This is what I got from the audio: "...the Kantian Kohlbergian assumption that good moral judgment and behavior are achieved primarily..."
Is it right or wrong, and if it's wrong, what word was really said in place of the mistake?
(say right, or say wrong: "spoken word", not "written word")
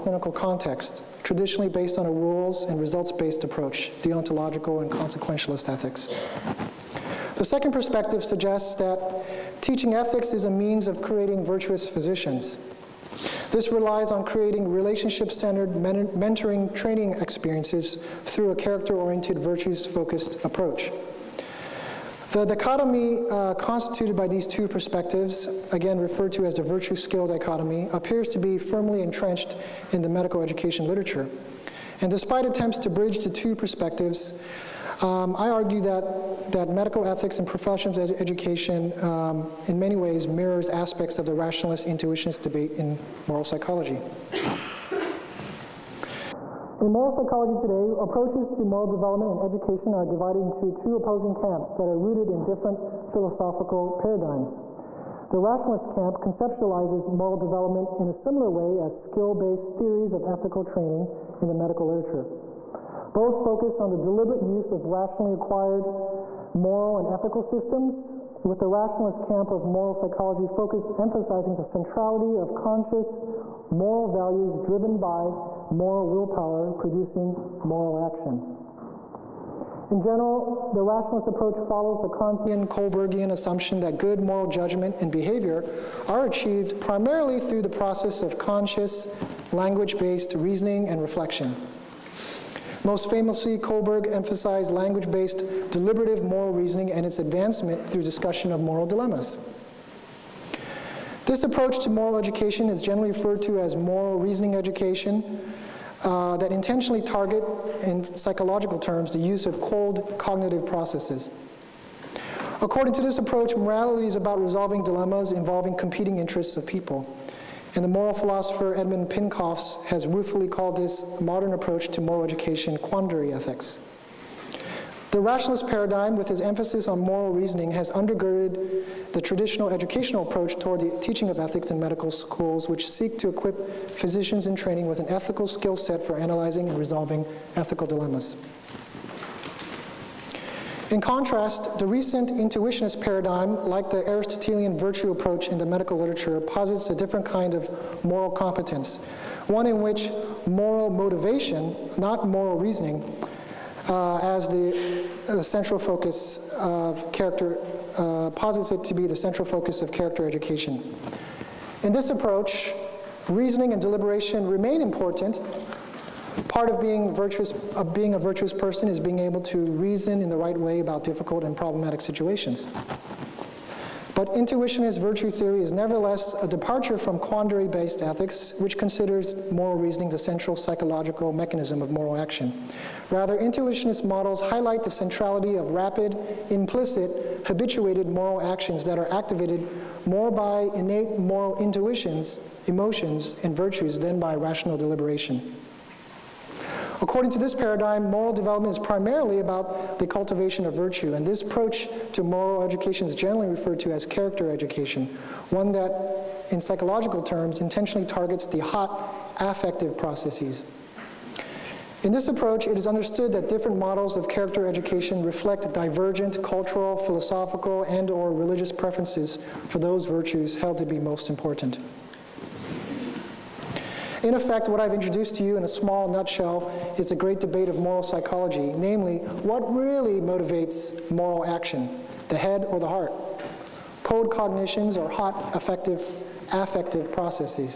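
right.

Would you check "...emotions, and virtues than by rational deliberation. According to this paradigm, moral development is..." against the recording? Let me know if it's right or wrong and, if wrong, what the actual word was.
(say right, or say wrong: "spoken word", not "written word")
right.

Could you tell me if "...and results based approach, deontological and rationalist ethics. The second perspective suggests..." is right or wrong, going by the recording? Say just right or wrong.
wrong.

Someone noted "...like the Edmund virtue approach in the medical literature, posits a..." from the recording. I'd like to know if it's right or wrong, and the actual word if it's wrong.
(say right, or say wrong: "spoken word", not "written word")
wrong: "Aristotelian", not "Edmund".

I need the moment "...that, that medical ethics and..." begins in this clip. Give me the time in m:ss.
0:35.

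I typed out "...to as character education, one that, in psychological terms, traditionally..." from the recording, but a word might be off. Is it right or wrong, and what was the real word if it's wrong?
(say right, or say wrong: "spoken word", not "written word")
wrong: "intentionally", not "traditionally".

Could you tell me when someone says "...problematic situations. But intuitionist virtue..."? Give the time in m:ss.
2:51.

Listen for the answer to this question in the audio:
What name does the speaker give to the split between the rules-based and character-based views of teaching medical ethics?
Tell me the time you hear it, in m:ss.
0:26.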